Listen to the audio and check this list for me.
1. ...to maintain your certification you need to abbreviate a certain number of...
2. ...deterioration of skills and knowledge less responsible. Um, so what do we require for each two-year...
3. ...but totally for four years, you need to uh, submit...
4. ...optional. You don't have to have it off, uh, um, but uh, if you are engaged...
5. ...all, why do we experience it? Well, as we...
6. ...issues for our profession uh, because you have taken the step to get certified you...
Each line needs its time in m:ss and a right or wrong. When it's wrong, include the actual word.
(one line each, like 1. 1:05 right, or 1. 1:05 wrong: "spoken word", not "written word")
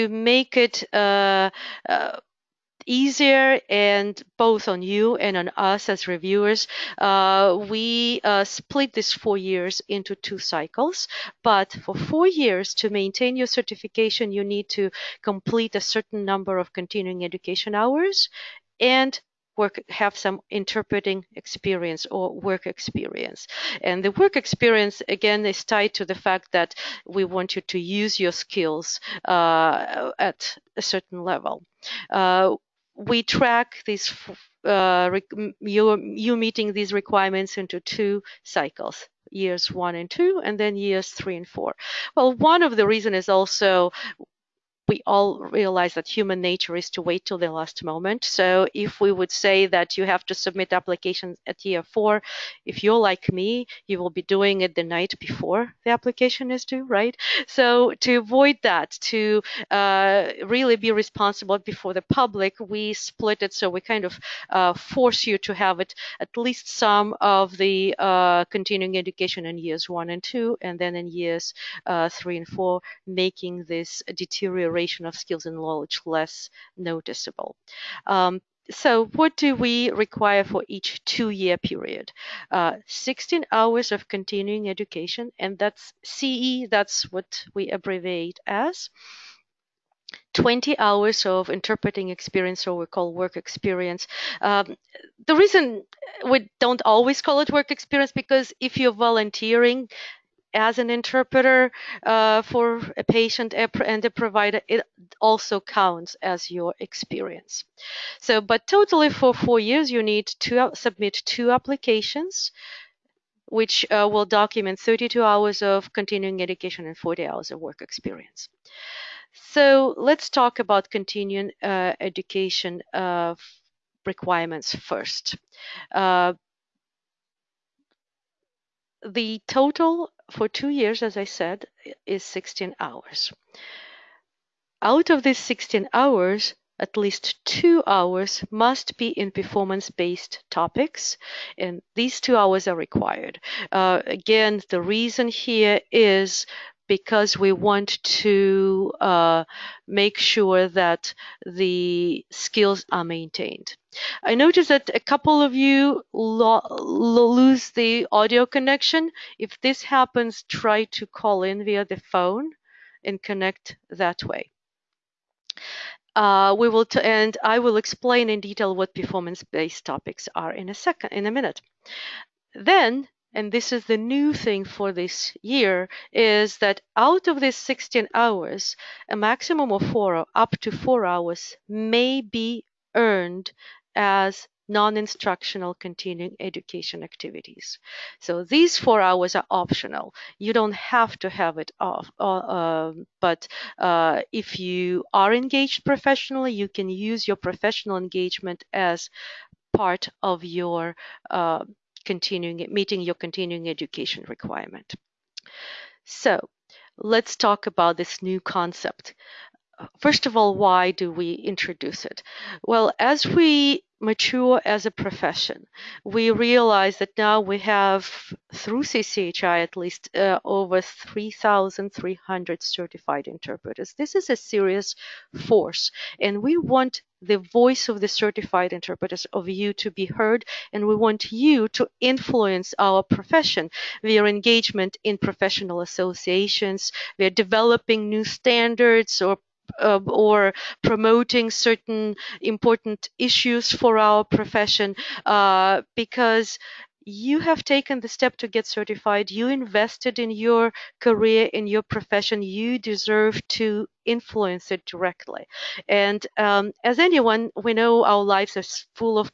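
1. 0:12 wrong: "complete", not "abbreviate"
2. 1:14 wrong: "noticeable", not "responsible"
3. 1:48 right
4. 3:09 right
5. 3:30 wrong: "introduce", not "experience"
6. 4:03 right.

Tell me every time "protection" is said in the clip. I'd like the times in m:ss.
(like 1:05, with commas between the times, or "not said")
not said.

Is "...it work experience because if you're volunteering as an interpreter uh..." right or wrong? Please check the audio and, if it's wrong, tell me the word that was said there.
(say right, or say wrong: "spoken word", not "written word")
right.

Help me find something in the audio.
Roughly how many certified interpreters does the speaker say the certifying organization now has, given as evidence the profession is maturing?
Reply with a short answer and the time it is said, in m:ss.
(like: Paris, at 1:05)
over 3,300, at 3:40.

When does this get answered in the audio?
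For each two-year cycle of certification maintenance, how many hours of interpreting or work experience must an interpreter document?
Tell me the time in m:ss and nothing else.
1:30.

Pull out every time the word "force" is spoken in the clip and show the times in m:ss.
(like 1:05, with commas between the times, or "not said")
1:04, 3:45.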